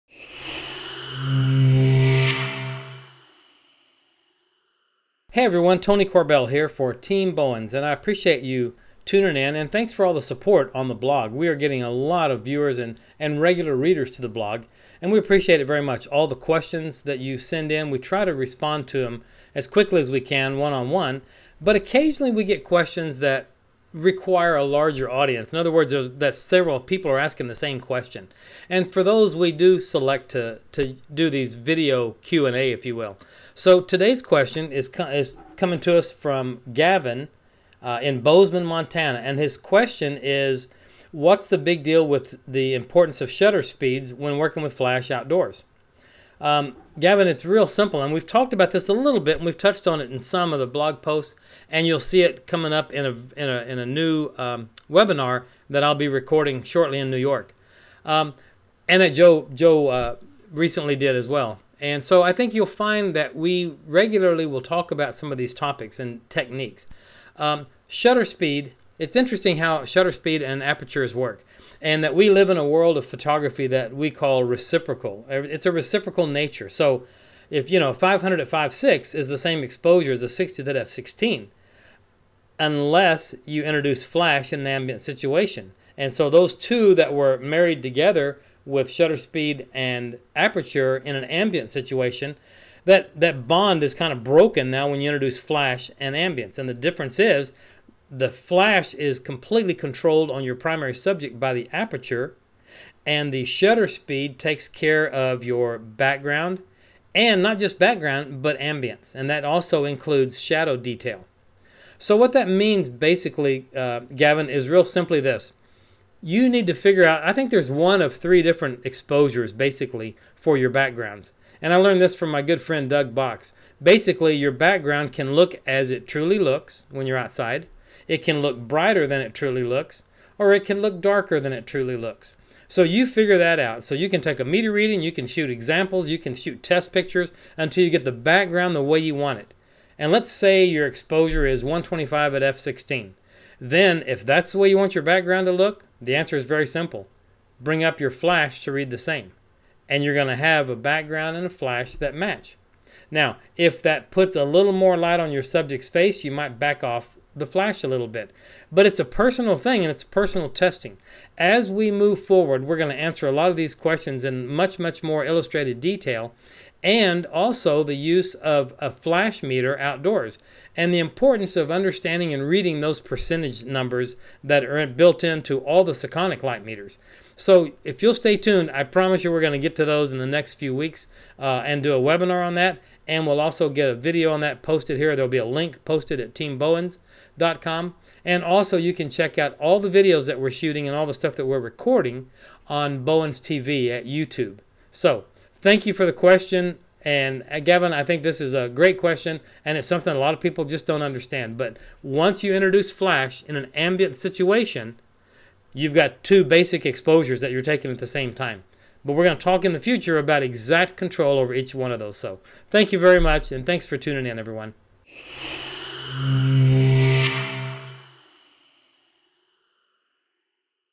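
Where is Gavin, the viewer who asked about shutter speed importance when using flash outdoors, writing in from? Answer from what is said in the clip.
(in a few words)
Bozeman, Montana.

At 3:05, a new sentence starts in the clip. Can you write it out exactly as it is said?
There'll be a link posted at teambowens.com.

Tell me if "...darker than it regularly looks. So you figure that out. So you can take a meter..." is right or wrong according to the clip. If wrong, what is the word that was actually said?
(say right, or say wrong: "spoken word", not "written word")
wrong: "truly", not "regularly".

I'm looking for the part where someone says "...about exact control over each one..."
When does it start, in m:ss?
3:30.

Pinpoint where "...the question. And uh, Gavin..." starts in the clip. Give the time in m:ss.
3:16.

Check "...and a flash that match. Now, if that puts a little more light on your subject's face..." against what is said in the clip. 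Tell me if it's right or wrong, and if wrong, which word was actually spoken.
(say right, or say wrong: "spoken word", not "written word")
right.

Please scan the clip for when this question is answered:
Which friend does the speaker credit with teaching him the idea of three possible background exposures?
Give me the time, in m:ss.
2:02.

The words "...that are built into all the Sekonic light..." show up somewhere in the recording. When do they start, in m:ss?
2:54.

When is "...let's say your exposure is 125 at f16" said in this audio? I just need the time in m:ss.
2:20.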